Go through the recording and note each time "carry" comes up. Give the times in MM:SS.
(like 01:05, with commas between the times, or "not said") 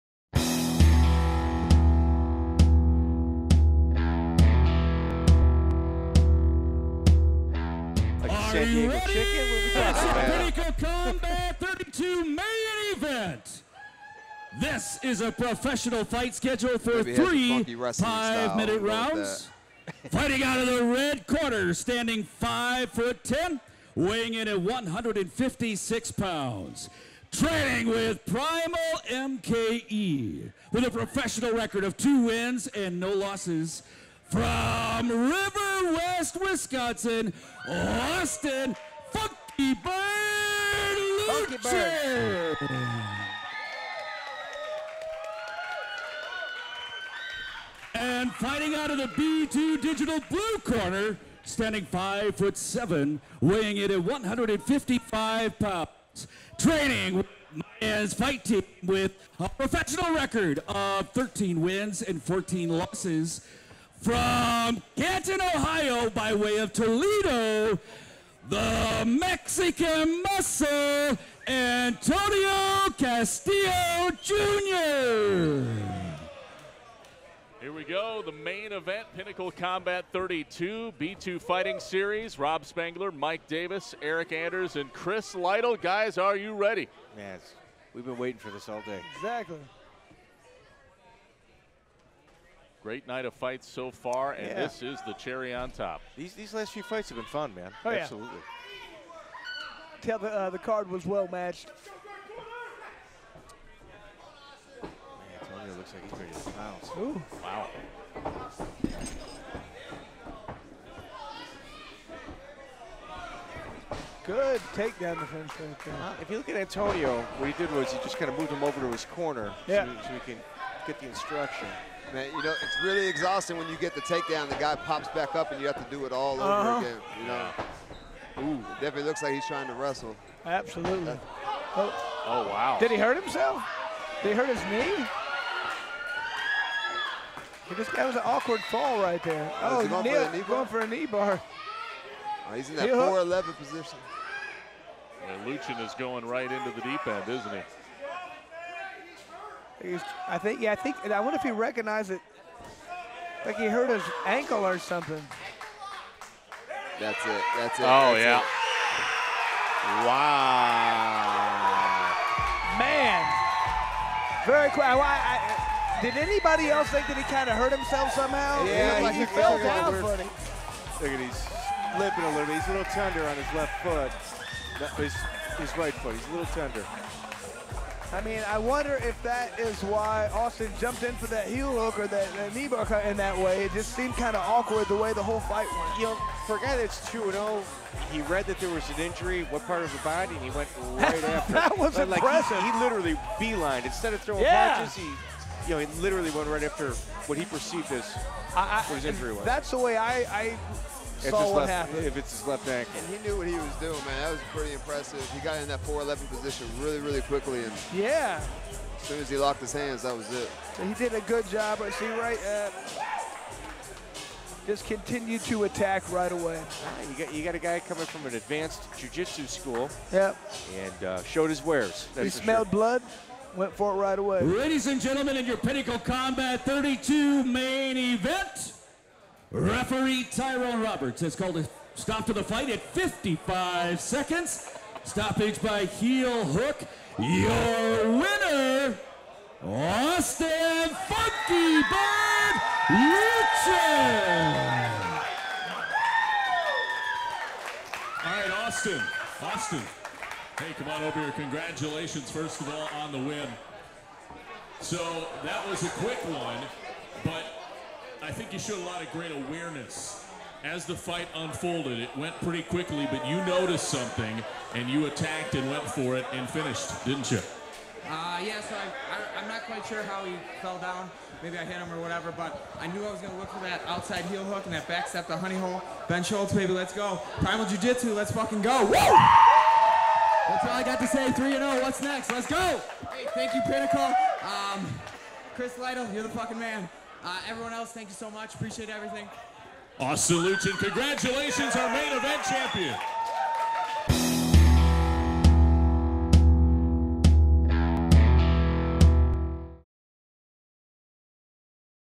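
not said.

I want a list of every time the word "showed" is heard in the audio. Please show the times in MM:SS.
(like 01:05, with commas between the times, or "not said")
03:41, 04:18.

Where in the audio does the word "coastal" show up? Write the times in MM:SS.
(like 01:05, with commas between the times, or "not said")
not said.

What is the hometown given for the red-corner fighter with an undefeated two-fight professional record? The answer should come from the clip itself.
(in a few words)
River West, Wisconsin.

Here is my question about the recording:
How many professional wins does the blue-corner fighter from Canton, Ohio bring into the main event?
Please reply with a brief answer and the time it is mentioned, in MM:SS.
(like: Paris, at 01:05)
13, at 01:01.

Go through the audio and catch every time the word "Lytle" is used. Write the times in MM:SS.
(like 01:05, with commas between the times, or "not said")
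01:25, 04:45.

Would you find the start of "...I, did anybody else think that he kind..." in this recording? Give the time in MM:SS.
02:45.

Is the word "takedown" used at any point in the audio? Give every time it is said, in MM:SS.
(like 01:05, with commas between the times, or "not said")
01:54, 02:04.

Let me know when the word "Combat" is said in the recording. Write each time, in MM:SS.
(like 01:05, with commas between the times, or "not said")
00:10, 01:19, 03:45.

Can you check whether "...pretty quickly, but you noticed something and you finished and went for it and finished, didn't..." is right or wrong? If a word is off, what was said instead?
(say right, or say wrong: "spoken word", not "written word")
wrong: "attacked", not "finished".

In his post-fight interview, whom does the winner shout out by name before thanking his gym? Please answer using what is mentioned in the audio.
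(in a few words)
Ben Schultz.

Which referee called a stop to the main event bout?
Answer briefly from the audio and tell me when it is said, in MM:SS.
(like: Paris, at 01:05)
Tyrone Roberts, at 03:50.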